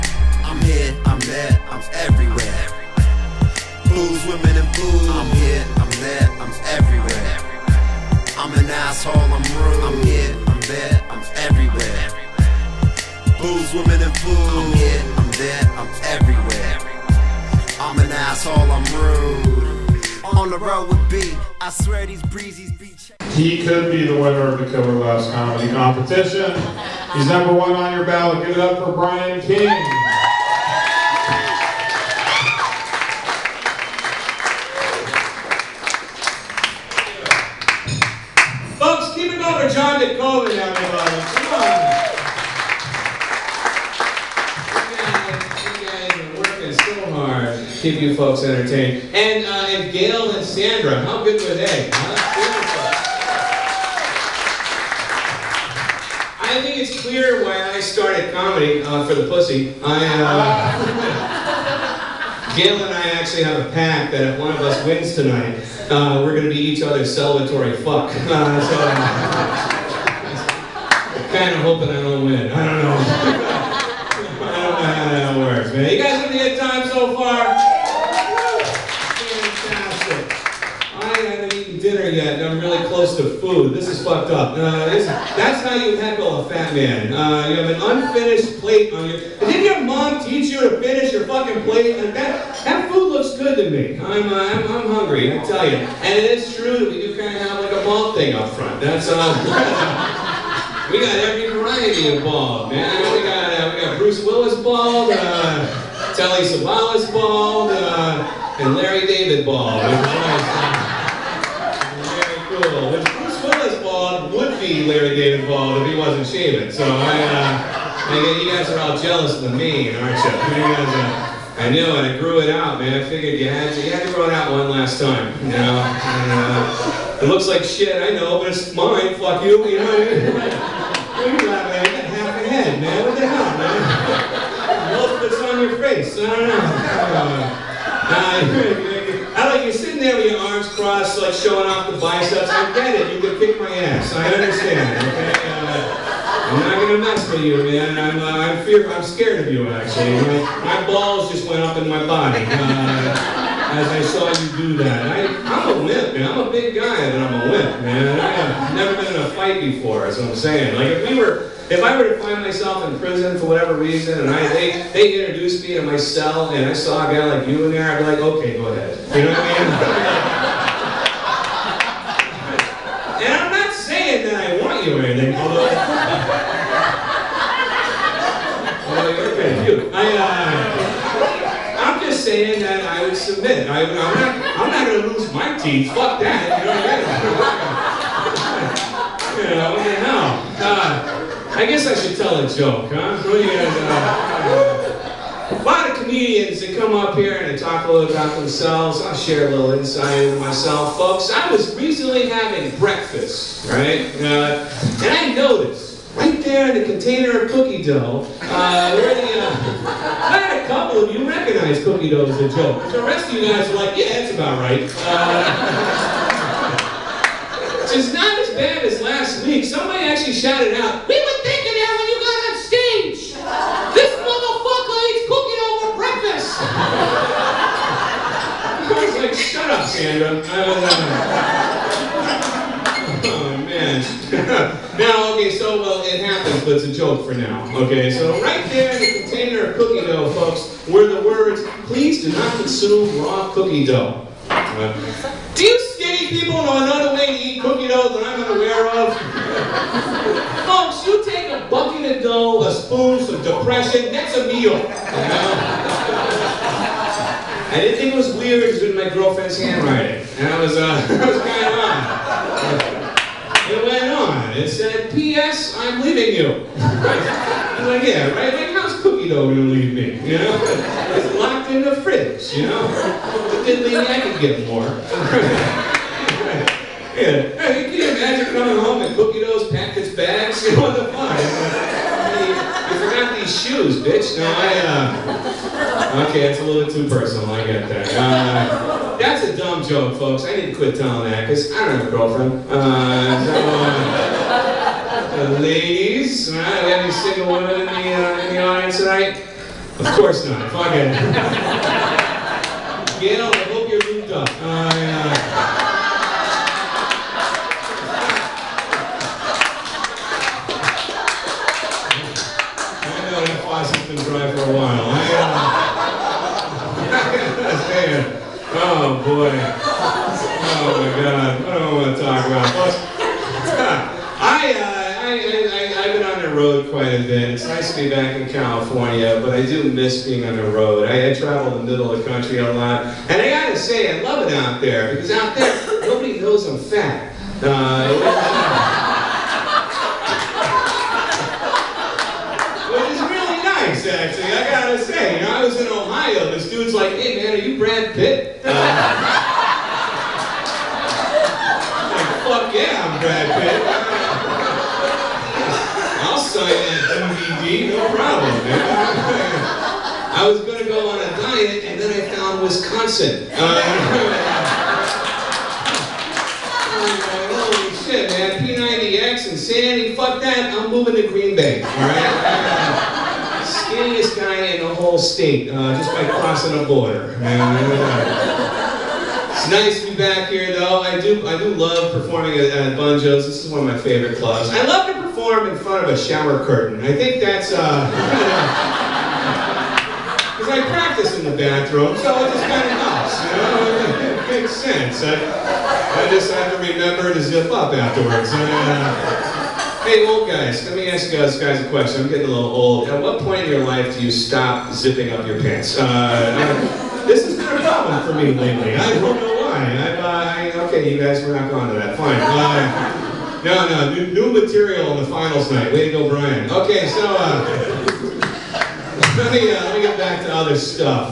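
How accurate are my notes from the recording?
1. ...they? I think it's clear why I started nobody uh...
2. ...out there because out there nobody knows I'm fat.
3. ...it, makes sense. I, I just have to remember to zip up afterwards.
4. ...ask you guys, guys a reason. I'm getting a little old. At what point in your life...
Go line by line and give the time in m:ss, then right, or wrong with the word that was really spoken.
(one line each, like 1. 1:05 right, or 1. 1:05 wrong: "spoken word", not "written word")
1. 0:51 wrong: "comedy", not "nobody"
2. 5:34 right
3. 6:34 right
4. 6:41 wrong: "question", not "reason".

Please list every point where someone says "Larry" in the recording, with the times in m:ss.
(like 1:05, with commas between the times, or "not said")
1:48, 1:54.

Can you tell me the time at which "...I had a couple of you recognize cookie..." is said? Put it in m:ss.
3:29.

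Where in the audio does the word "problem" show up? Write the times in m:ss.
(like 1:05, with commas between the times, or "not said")
5:58, 6:47.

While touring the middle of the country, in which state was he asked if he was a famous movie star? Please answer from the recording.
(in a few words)
Ohio.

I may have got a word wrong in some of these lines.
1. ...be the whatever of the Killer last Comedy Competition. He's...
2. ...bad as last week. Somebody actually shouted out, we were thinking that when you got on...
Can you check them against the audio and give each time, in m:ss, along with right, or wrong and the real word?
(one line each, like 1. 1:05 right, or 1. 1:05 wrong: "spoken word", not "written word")
1. 0:23 wrong: "winner", not "whatever"
2. 3:38 right.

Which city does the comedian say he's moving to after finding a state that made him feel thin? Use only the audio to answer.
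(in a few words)
Green Bay.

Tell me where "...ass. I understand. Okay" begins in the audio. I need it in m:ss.
2:23.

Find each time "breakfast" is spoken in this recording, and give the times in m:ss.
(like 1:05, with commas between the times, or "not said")
3:22, 3:45.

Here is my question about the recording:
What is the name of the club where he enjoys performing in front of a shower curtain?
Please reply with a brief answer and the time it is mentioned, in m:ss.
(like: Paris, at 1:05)
Bunjo's, at 6:22.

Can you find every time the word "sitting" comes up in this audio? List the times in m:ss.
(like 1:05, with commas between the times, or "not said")
2:19.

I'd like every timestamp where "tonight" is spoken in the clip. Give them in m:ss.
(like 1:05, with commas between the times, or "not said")
1:05, 4:58.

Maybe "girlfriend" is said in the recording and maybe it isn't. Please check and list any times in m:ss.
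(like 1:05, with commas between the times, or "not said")
4:19, 4:52.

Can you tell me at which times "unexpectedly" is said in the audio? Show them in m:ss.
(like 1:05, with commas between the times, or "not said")
not said.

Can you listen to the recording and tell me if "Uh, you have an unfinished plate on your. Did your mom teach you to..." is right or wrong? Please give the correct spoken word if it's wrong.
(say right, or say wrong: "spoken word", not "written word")
right.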